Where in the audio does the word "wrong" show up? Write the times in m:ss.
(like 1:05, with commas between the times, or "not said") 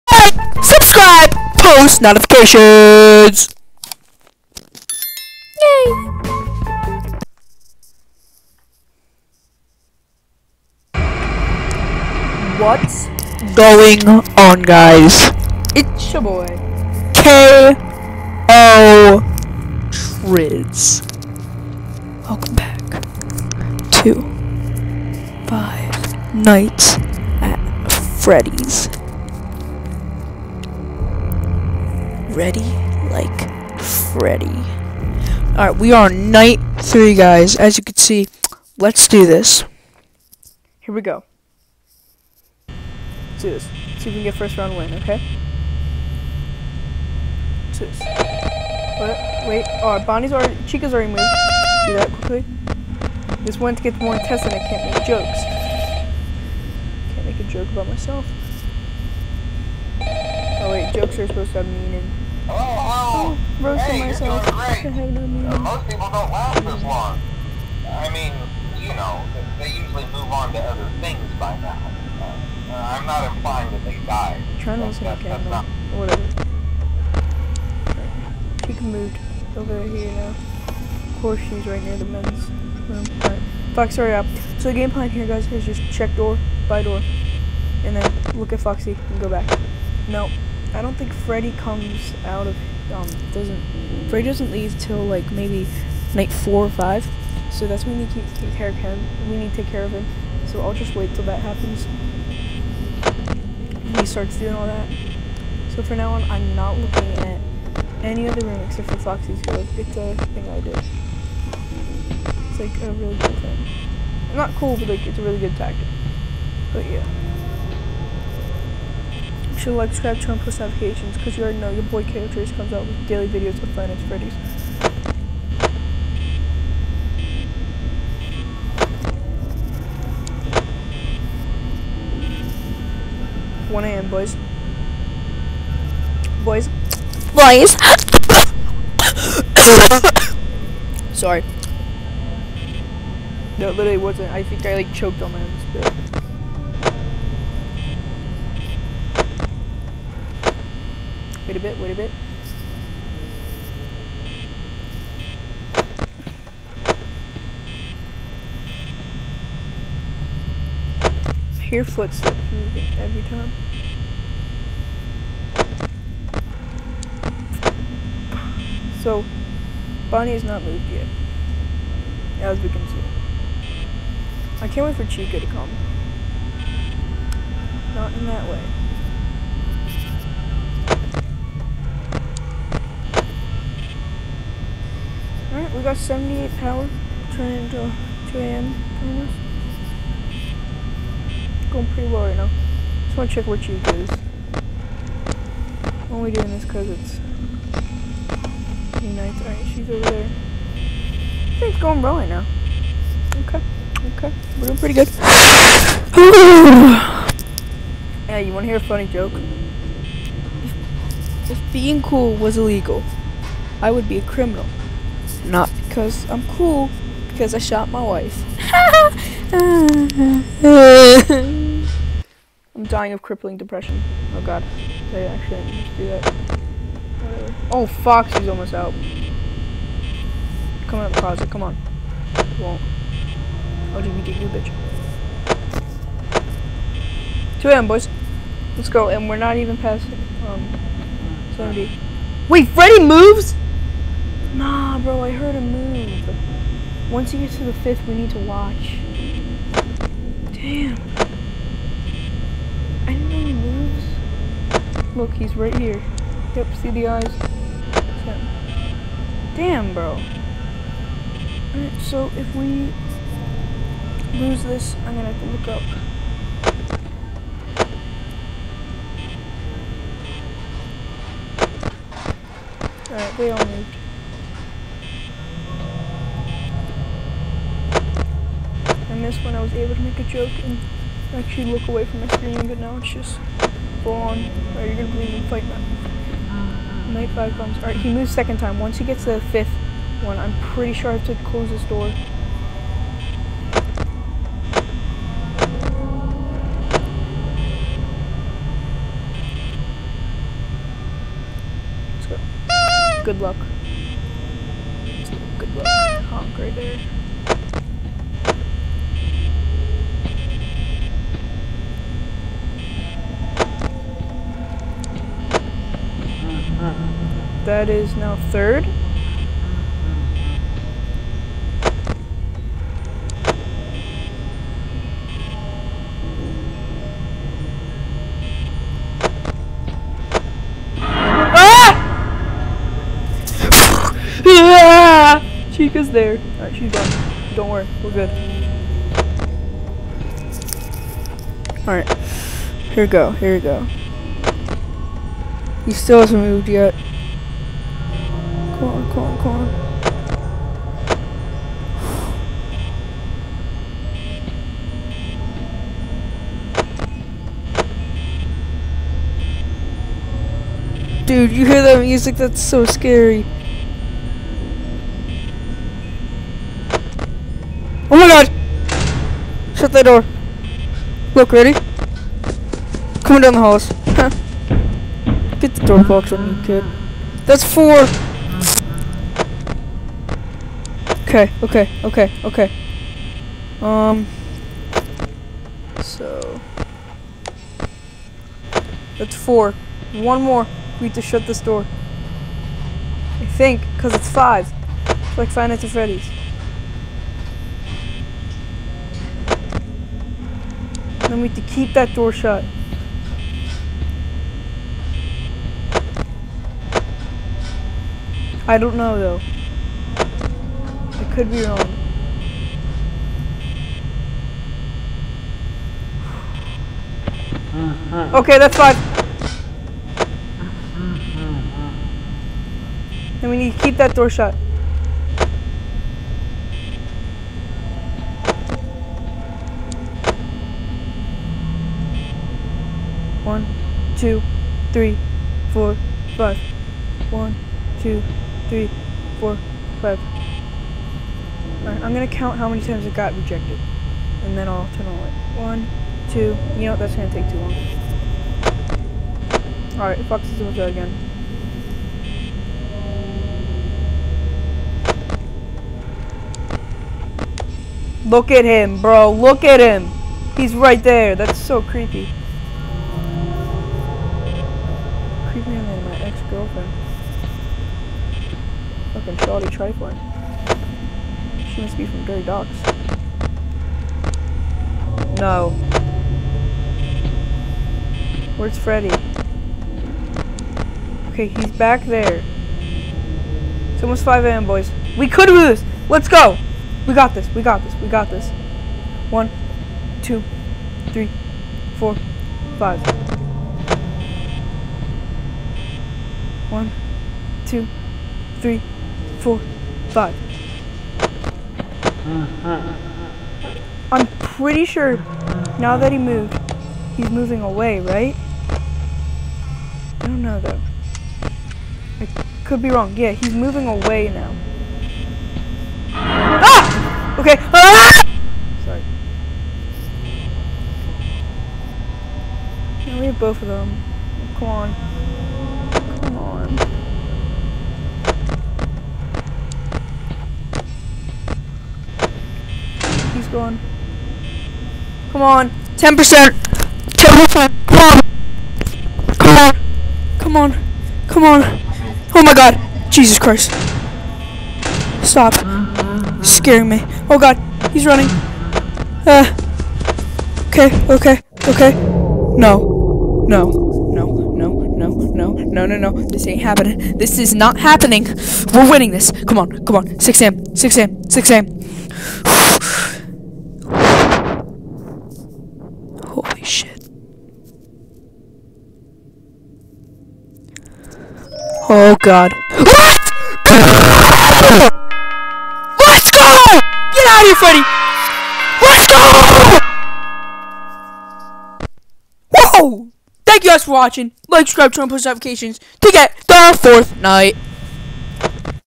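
6:51, 8:32.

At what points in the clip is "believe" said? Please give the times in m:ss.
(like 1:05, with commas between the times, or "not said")
4:45.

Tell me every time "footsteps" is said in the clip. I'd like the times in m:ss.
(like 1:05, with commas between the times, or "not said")
2:41.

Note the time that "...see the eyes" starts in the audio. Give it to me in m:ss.
4:16.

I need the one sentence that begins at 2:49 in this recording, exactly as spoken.
So, Bonnie has not moved yet, as we can see.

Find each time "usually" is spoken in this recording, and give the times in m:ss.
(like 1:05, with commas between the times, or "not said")
1:09.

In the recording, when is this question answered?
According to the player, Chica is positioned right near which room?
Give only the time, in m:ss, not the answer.
1:22.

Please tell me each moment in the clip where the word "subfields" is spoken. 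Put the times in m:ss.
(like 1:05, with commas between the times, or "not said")
not said.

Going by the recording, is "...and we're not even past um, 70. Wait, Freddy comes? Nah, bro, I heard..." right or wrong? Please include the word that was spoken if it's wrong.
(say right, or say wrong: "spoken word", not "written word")
wrong: "moves", not "comes".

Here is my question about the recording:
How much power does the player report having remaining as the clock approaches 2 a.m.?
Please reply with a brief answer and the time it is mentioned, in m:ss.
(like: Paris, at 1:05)
78, at 3:05.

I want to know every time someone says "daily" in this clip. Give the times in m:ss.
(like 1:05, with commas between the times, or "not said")
2:03.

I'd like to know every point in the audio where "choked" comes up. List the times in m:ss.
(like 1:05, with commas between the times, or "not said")
2:24.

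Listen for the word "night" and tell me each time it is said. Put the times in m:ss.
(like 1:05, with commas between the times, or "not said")
0:26, 0:36, 1:36, 3:19, 4:47, 6:35, 9:47.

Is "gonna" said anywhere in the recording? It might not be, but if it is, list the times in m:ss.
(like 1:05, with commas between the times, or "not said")
4:25, 4:45, 7:22, 7:27.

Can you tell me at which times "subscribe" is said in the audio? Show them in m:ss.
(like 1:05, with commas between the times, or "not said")
1:59, 9:44.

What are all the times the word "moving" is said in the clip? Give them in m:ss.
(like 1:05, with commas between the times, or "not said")
2:42, 8:27, 8:33.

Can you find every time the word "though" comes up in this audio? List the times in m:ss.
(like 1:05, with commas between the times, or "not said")
6:49, 8:30.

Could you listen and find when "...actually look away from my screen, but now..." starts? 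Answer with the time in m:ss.
4:41.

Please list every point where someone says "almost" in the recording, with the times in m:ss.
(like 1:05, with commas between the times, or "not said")
3:09, 3:48, 8:04.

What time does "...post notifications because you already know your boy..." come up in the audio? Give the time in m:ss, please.
2:00.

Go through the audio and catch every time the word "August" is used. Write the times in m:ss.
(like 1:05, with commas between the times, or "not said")
not said.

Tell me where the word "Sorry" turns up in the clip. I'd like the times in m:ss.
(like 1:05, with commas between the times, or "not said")
2:21, 8:38.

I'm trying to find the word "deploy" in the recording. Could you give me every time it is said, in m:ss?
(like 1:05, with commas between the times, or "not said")
not said.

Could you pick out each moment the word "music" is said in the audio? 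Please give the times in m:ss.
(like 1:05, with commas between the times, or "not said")
6:02.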